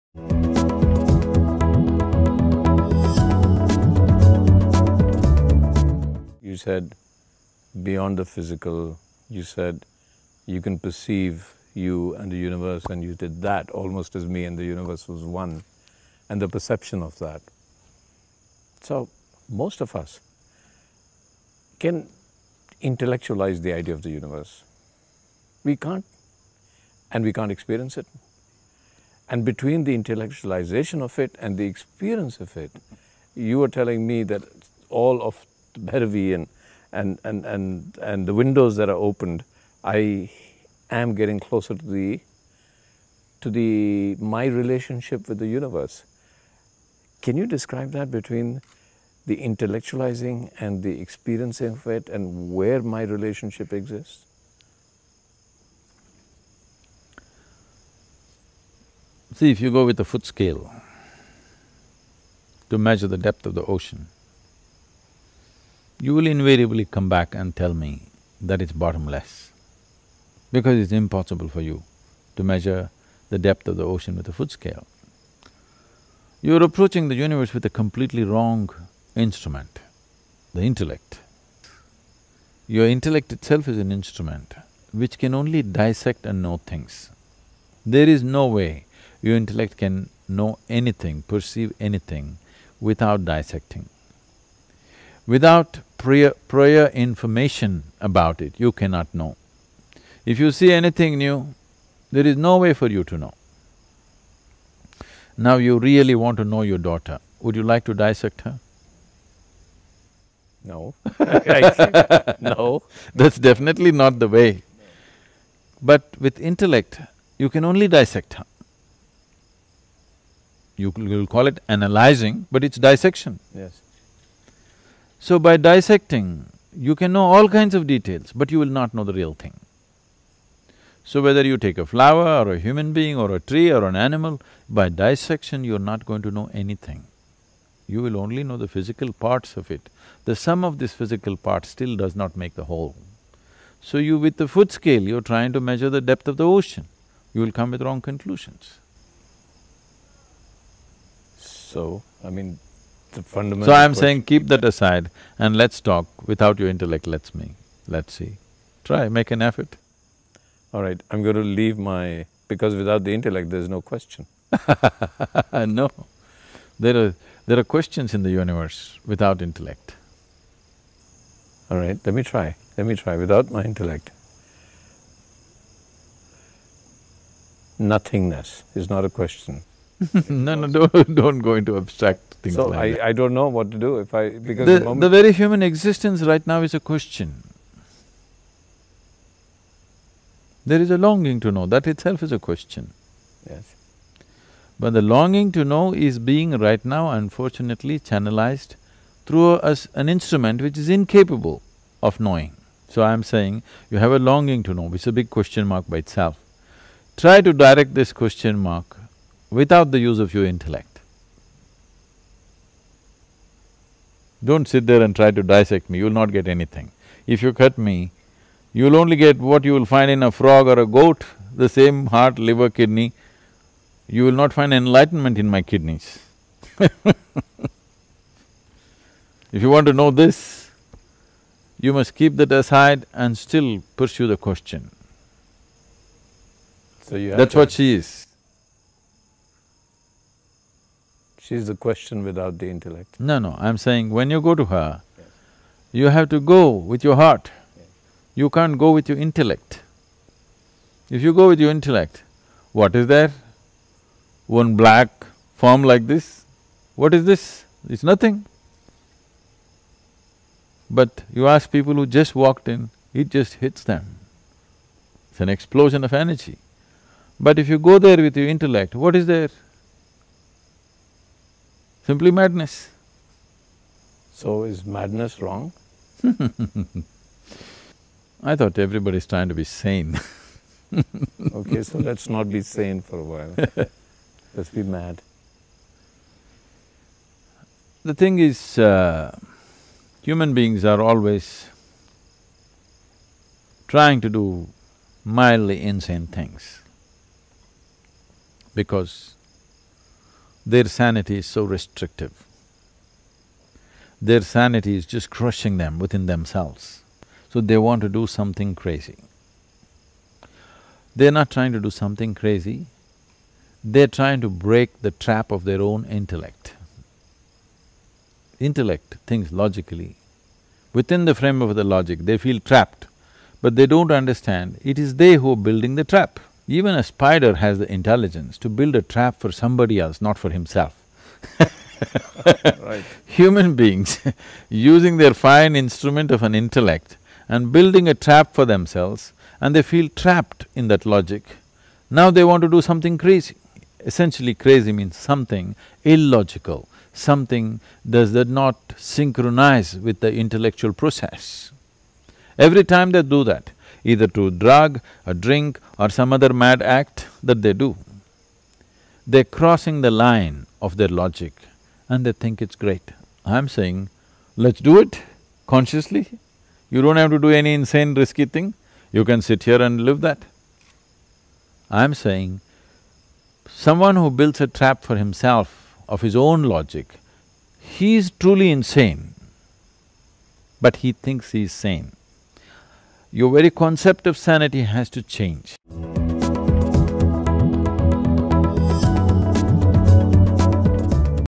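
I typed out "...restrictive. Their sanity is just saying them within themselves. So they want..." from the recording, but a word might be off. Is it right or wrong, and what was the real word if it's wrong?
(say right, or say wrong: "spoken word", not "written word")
wrong: "crushing", not "saying".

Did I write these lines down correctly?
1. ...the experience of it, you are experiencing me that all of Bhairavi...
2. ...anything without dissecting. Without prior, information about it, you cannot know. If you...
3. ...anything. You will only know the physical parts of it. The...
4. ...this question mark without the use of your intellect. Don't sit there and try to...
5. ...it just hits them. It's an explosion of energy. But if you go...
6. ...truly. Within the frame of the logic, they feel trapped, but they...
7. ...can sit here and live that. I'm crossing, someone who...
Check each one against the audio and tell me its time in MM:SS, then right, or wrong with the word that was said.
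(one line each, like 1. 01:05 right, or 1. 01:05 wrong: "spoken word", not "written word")
1. 00:31 wrong: "telling", not "experiencing"
2. 01:31 right
3. 02:16 right
4. 03:27 right
5. 04:23 right
6. 05:19 wrong: "logically", not "truly"
7. 06:09 wrong: "saying", not "crossing".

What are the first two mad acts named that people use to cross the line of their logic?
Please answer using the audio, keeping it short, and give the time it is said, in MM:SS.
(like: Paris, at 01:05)
drug or drink, at 05:54.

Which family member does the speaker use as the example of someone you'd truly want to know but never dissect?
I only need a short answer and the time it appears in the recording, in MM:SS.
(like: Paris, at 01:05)
daughter, at 01:46.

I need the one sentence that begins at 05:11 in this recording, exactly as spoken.
They're not trying to do something crazy, they're trying to break the trap of their own intellect.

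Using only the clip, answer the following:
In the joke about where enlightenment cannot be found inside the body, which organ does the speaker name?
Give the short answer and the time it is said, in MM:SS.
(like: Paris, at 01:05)
kidneys, at 03:45.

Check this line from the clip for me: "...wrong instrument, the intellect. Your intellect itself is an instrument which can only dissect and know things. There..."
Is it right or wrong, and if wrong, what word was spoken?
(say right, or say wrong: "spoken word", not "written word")
right.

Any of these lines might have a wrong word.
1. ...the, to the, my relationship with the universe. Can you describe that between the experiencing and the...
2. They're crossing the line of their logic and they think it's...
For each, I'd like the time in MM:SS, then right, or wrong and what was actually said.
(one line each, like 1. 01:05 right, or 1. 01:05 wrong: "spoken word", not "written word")
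1. 00:41 wrong: "intellectualizing", not "experiencing"
2. 05:59 right.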